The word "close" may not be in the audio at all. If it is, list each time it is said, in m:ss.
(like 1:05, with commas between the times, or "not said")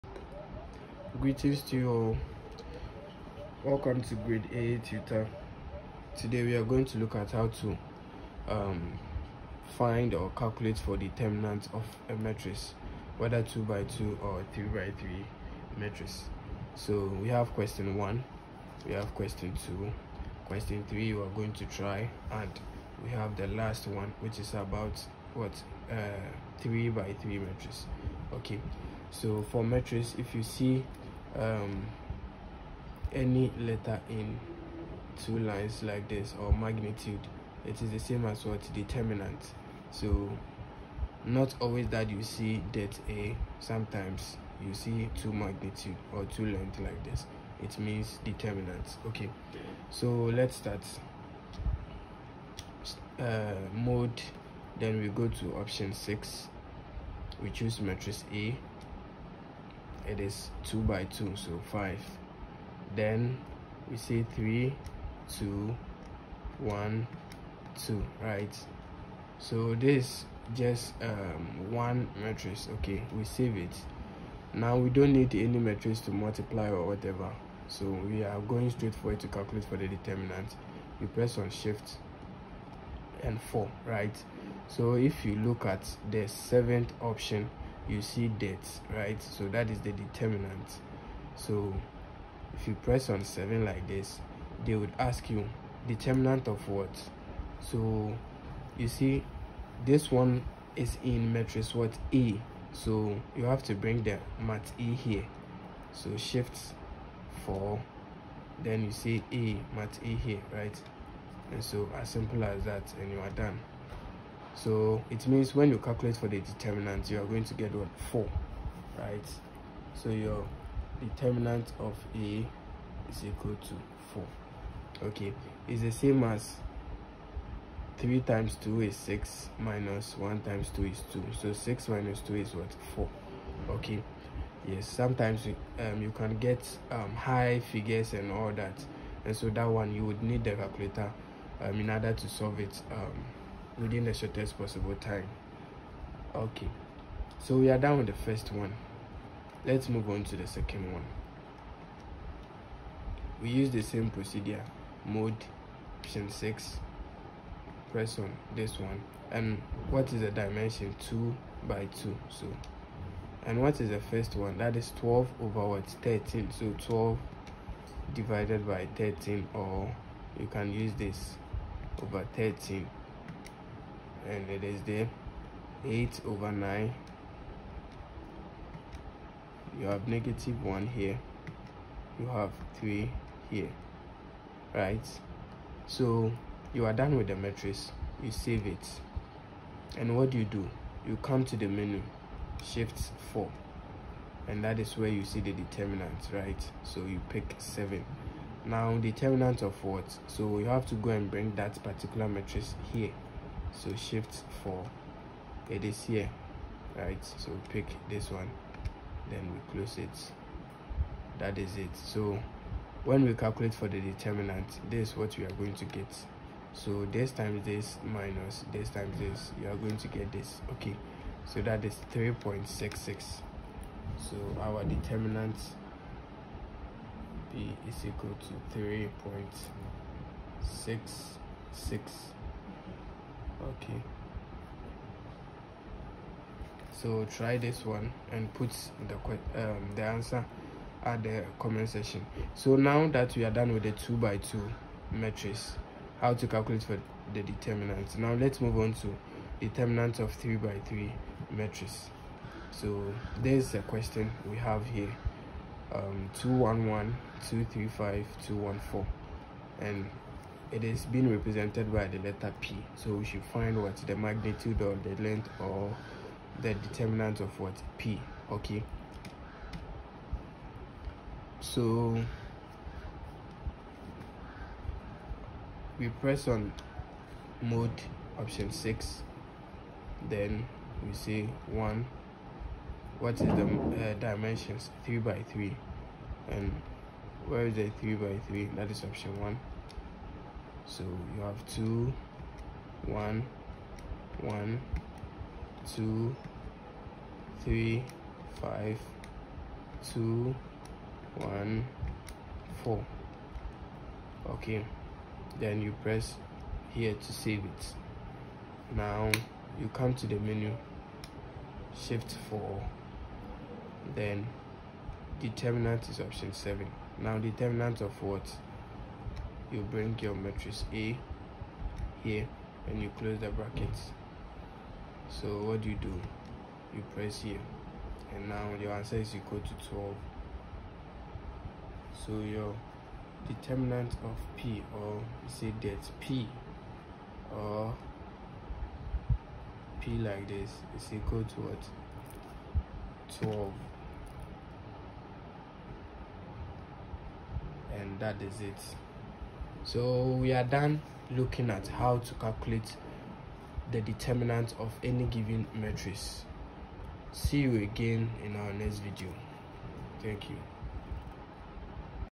3:29, 5:23.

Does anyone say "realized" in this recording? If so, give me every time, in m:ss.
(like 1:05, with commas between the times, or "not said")
not said.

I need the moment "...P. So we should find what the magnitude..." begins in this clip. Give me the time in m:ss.
4:22.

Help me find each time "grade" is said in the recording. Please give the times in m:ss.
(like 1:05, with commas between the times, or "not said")
0:04.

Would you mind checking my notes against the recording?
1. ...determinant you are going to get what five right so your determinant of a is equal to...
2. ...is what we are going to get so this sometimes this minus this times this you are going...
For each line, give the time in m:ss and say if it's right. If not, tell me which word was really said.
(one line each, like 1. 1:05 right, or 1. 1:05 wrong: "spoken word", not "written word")
1. 1:56 wrong: "four", not "five"
2. 3:35 wrong: "times", not "sometimes".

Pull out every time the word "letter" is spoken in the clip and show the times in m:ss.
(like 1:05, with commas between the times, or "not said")
0:33, 4:22.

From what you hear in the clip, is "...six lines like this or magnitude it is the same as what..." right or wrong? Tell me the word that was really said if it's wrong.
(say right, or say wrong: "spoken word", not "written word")
wrong: "two", not "six".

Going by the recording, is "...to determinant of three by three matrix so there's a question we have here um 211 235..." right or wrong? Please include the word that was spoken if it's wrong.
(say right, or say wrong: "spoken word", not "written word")
right.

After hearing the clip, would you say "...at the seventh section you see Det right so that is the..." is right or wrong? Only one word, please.
wrong.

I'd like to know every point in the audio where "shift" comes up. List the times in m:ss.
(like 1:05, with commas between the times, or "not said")
1:21, 1:46, 3:12, 3:23, 5:11.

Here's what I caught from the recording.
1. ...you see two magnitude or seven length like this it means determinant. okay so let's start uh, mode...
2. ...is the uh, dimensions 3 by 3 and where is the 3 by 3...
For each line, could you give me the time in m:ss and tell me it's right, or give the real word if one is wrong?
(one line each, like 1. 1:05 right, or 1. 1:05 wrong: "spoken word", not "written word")
1. 0:44 wrong: "two", not "seven"
2. 4:43 right.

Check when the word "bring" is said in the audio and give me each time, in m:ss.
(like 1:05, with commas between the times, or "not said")
1:43, 3:21, 5:19.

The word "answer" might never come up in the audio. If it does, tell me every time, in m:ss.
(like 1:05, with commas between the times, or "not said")
4:00, 5:28.